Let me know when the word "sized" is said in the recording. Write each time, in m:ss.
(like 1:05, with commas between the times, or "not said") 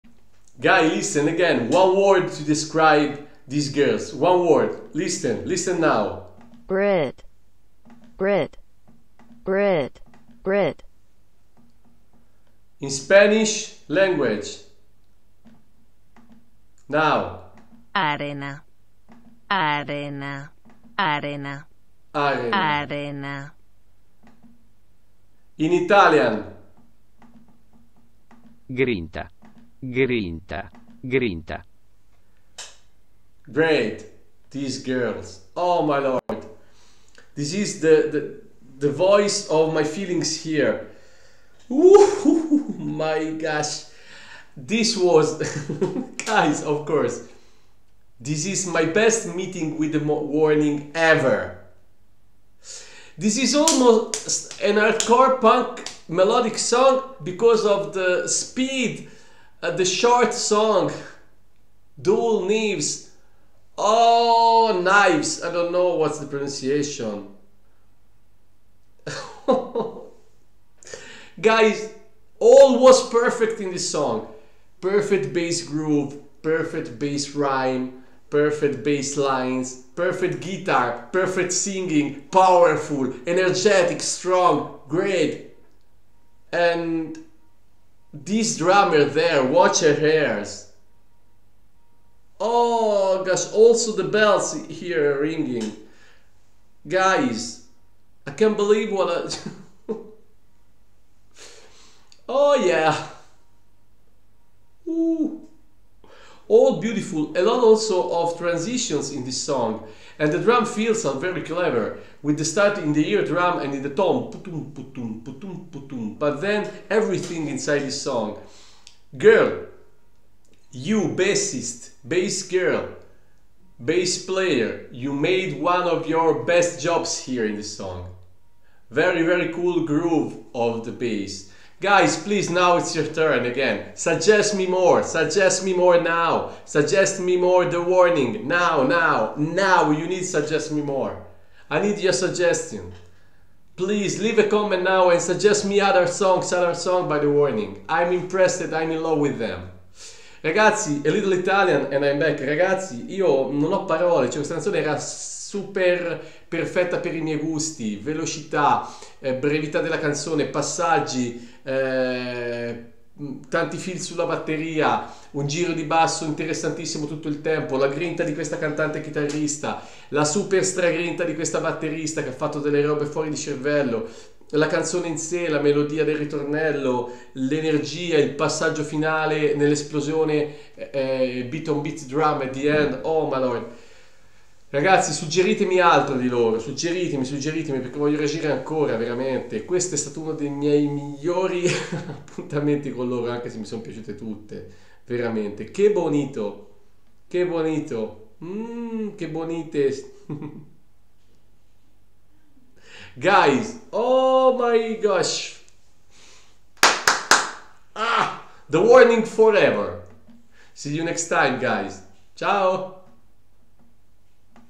not said.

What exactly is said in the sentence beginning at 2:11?
Guys, please, now it's your turn again.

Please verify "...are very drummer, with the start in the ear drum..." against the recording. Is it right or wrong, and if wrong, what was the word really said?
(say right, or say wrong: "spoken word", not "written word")
wrong: "clever", not "drummer".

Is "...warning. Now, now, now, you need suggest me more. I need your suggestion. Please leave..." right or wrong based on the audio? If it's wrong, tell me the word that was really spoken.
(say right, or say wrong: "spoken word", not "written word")
right.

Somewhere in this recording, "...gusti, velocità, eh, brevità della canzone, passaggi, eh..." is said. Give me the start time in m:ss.
2:37.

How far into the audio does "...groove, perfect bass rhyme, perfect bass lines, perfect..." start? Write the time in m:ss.
1:15.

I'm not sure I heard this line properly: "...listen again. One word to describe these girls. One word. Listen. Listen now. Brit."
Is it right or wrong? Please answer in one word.
right.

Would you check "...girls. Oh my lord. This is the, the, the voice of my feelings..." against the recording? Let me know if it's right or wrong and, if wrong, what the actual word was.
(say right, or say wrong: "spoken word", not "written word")
right.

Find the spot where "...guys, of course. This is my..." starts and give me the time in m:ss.
0:46.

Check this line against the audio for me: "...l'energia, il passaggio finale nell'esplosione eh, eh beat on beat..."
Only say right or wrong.
right.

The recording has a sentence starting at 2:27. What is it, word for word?
I'm impressed, I'm in love with them.